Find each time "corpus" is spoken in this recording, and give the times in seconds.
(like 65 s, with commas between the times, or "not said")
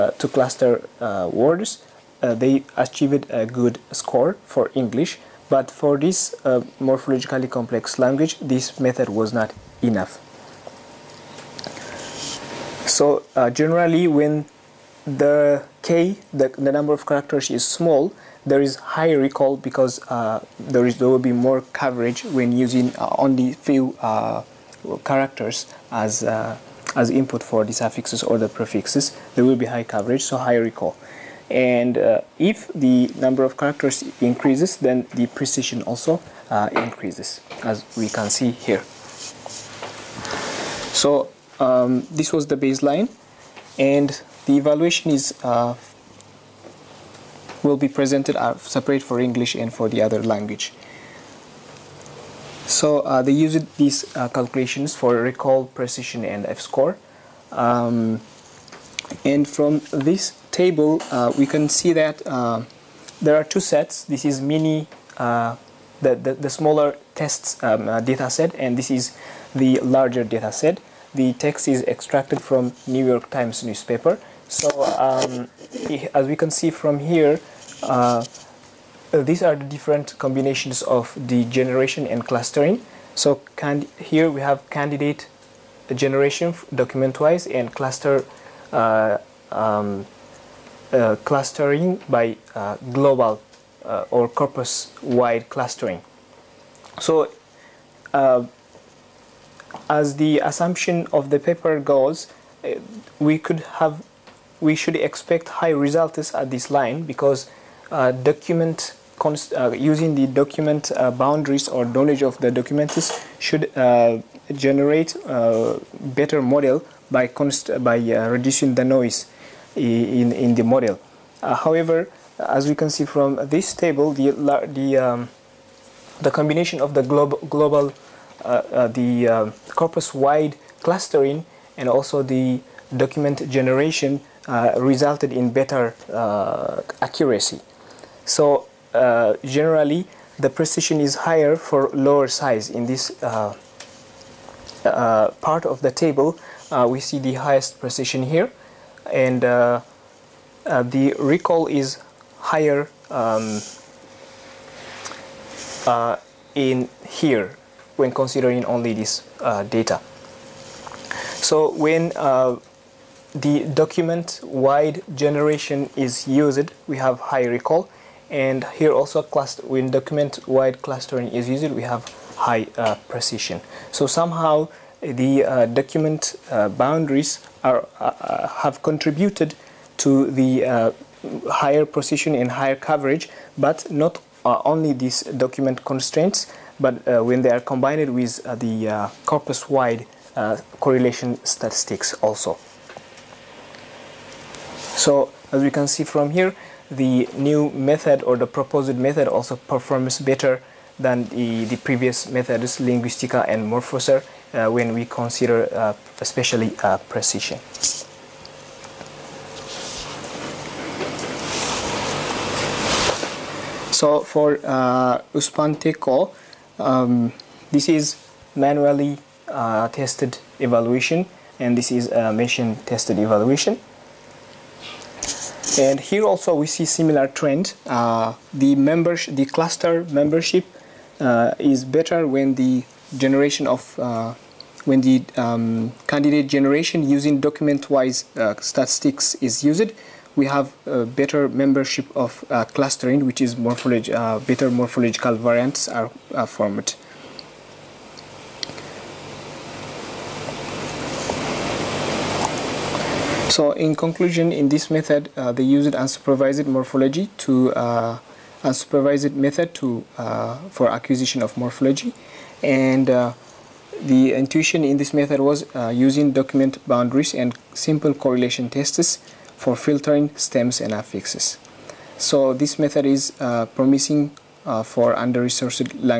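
94 s, 129 s, 189 s.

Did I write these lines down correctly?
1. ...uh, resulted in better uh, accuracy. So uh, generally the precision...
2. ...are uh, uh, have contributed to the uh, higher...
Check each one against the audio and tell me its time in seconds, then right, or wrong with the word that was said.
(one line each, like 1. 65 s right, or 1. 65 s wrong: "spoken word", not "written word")
1. 134 s right
2. 177 s right.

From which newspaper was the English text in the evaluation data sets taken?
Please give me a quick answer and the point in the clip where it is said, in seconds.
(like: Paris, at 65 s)
New York Times, at 72 s.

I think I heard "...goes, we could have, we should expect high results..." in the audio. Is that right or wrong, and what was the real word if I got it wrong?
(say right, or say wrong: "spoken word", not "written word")
right.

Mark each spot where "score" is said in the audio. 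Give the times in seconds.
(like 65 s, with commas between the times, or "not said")
3 s, 56 s.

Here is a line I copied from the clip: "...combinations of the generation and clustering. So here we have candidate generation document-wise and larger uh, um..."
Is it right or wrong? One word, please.
wrong.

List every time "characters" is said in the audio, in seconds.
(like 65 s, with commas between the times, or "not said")
17 s, 25 s, 33 s.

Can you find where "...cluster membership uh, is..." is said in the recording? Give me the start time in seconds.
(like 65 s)
229 s.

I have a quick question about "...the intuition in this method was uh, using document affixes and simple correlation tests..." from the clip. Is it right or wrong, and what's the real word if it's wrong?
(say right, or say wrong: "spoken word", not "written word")
wrong: "boundaries", not "affixes".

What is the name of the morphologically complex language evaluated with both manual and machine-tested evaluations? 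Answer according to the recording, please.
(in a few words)
Uspanteko.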